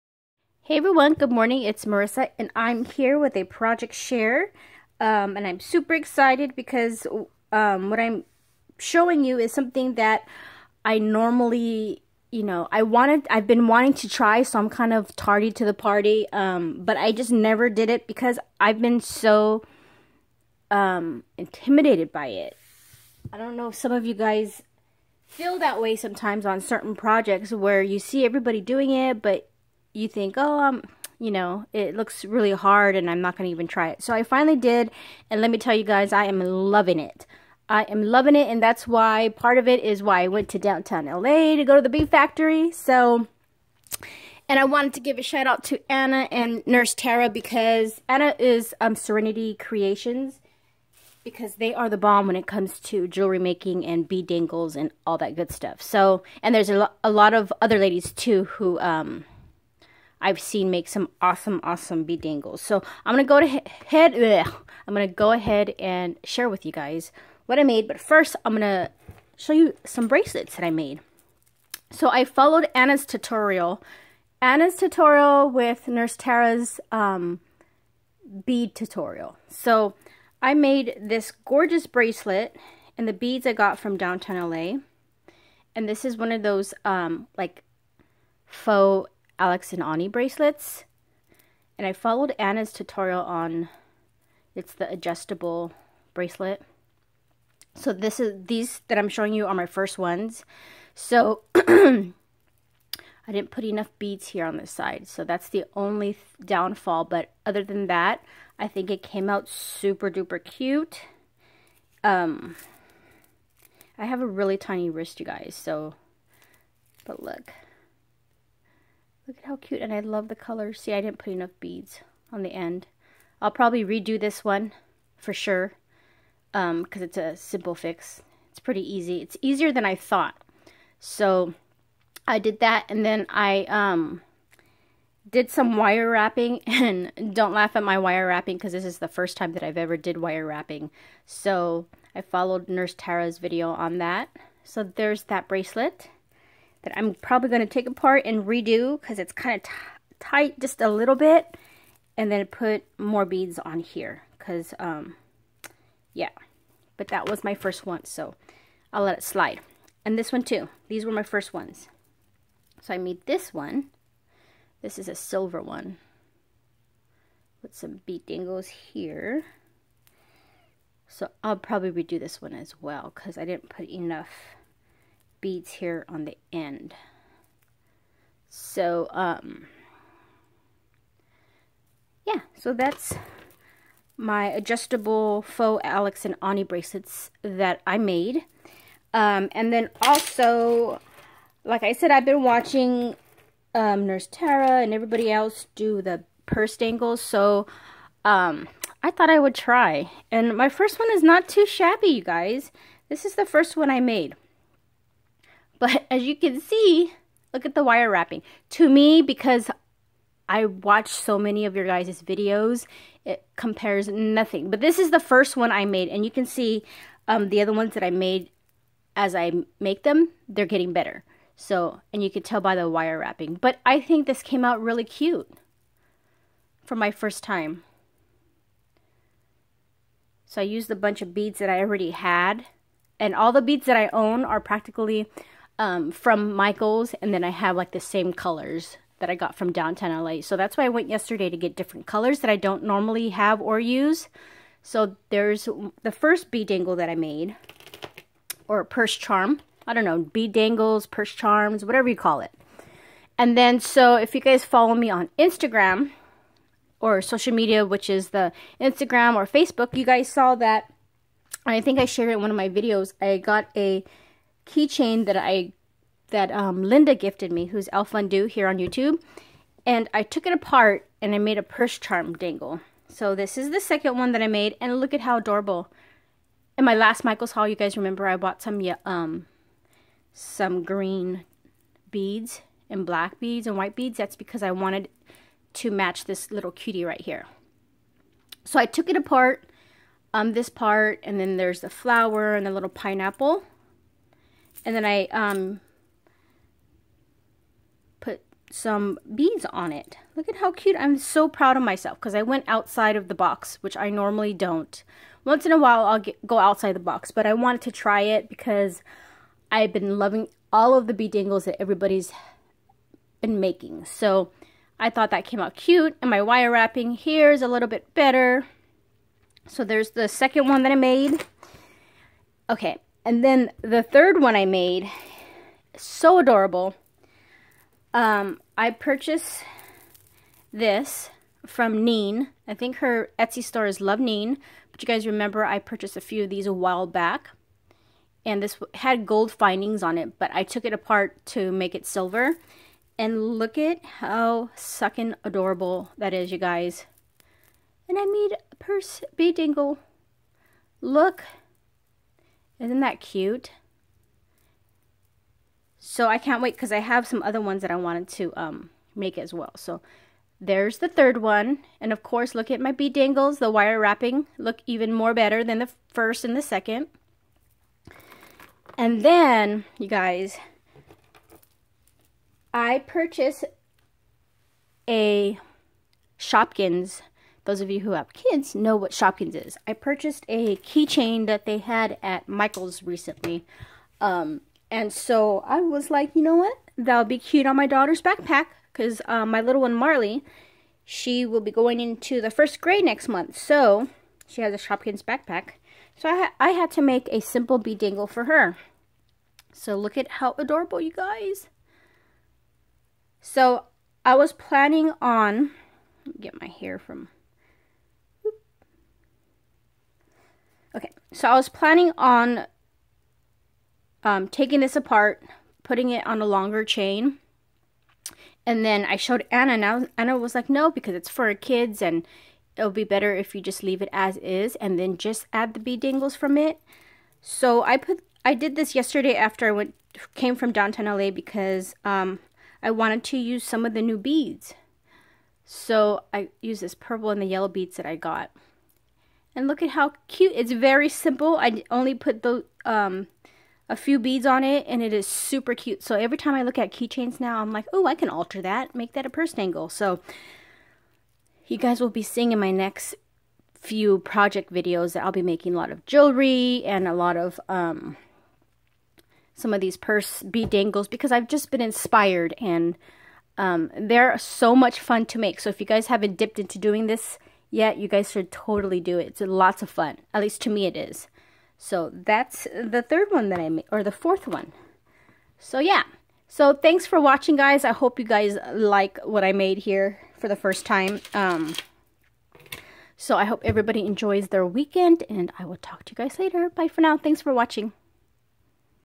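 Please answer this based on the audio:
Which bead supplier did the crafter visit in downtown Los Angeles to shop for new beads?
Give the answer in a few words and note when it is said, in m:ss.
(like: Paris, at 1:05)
Bee Factory, at 0:41.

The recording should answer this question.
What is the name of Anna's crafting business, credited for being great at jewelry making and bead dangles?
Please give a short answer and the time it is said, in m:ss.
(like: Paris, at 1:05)
Serenity Creations, at 0:48.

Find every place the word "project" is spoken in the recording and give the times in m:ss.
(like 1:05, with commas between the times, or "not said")
0:03, 0:26, 7:34.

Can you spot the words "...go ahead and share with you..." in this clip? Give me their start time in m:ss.
1:05.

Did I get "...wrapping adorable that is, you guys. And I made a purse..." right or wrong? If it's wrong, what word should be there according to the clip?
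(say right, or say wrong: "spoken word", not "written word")
wrong: "sucking", not "wrapping".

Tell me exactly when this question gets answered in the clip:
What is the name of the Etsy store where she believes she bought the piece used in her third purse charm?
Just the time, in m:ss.
5:34.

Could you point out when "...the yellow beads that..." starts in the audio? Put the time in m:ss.
7:17.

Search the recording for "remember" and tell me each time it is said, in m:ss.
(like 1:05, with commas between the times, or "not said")
4:37, 5:35.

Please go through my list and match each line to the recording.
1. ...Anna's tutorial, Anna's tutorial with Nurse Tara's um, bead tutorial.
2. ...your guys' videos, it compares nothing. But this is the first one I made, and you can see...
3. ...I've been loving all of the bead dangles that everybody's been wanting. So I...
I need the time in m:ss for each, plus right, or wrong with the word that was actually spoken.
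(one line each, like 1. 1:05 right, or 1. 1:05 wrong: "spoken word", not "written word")
1. 1:12 right
2. 3:31 right
3. 5:09 wrong: "making", not "wanting".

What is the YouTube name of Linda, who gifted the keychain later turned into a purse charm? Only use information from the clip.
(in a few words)
Elfundu.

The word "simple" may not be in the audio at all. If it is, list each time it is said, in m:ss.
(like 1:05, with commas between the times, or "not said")
2:07, 6:37, 7:21.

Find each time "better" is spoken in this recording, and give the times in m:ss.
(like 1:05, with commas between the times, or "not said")
3:40, 5:18, 6:05, 7:03.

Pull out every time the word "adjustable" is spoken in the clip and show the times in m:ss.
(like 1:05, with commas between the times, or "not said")
1:34, 3:04.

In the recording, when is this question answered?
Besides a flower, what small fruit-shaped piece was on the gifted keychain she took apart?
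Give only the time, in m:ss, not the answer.
4:52.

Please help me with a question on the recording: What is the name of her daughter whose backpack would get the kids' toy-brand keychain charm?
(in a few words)
Marley.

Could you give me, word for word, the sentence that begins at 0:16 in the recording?
Um, but I just never did it because I've been so um, intimidated by it.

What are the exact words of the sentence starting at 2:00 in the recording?
See, I didn't put enough beads on the end.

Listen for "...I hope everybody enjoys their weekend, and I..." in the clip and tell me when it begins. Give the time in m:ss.
8:03.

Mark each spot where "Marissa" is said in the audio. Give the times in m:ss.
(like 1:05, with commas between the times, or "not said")
0:01.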